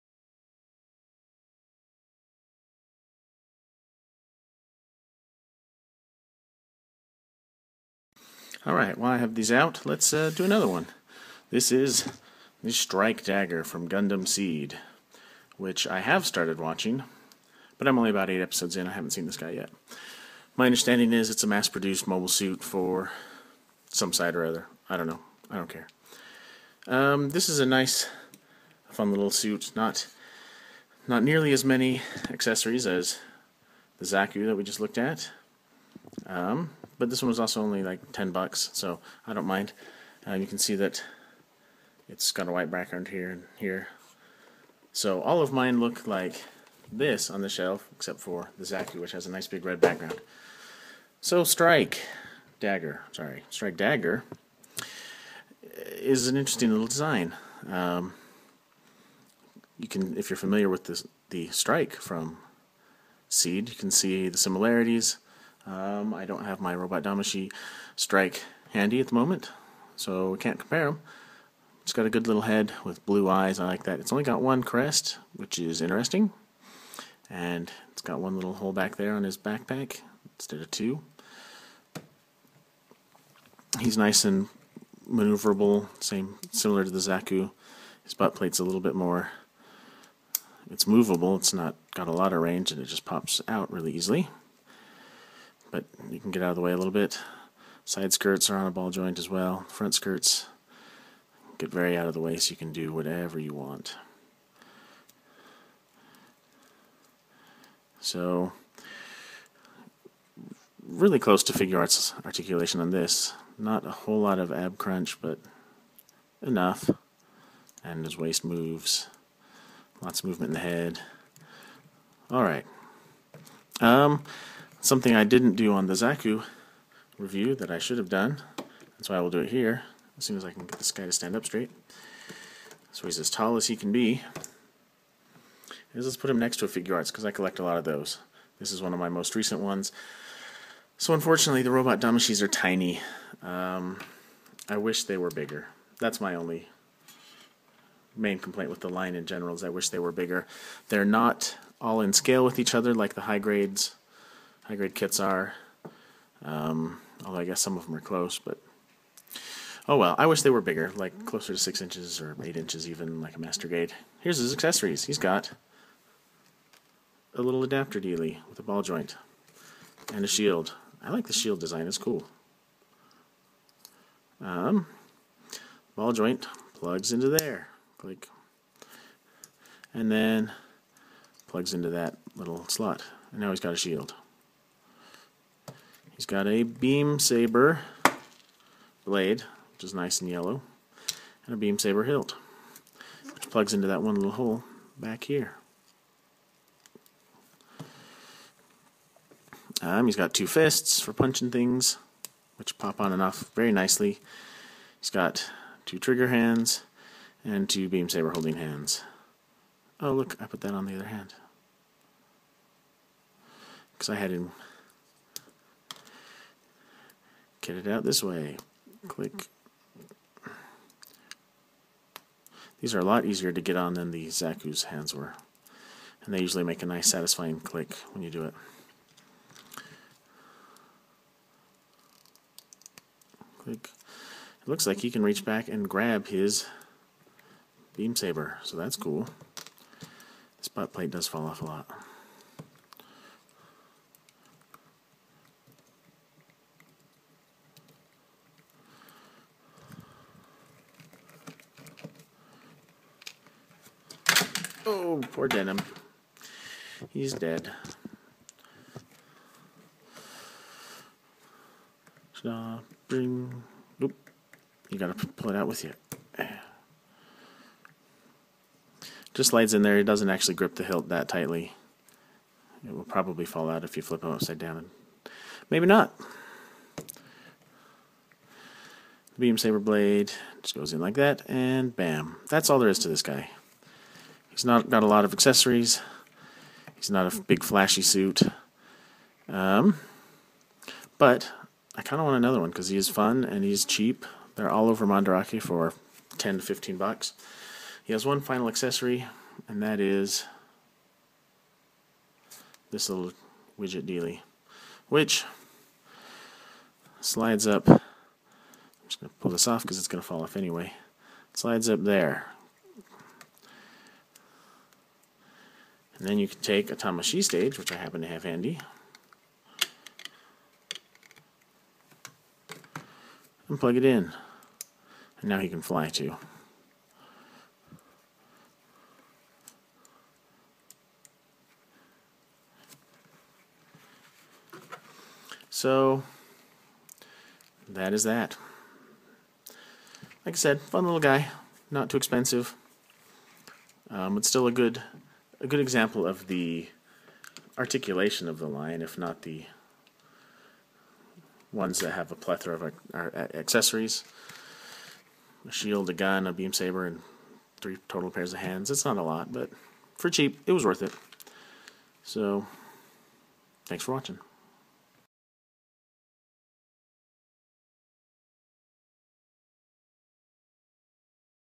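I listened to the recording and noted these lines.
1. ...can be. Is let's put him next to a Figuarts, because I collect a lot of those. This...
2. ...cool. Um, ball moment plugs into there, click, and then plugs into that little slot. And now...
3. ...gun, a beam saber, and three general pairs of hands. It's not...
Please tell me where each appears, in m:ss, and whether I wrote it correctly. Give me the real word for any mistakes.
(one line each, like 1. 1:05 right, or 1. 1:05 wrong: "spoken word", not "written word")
1. 2:13 right
2. 2:51 wrong: "joint", not "moment"
3. 5:56 wrong: "total", not "general".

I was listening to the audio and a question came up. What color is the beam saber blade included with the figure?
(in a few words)
Yellow.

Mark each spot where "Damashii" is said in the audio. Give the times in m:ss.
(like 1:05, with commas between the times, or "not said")
1:07, 2:22.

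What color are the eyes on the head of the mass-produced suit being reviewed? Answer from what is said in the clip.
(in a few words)
Blue.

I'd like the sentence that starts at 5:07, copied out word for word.
I'm just going to pull this off because it's going to fall off anyway.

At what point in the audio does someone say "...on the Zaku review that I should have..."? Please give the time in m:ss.
2:05.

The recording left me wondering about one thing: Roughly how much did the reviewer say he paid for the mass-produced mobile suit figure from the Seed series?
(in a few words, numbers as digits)
10 bucks.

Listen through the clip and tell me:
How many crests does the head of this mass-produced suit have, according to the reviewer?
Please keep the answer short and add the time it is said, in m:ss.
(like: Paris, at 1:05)
1, at 1:14.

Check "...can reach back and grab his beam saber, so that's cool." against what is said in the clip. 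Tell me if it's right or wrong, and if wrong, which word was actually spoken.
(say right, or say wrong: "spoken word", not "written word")
right.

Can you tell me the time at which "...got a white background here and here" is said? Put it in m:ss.
0:42.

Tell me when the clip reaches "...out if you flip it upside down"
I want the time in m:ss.
4:33.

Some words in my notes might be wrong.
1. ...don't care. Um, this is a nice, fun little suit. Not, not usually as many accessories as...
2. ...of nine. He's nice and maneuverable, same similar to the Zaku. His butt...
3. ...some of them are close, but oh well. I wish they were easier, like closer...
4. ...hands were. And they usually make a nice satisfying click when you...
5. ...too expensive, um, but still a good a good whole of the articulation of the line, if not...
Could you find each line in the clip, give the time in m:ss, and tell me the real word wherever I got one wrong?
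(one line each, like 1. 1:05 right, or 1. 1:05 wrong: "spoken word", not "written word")
1. 0:25 wrong: "nearly", not "usually"
2. 1:20 wrong: "two", not "nine"
3. 2:37 wrong: "bigger", not "easier"
4. 3:44 right
5. 5:42 wrong: "example", not "whole".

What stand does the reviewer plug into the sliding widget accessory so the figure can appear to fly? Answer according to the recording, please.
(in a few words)
Tamashii stage.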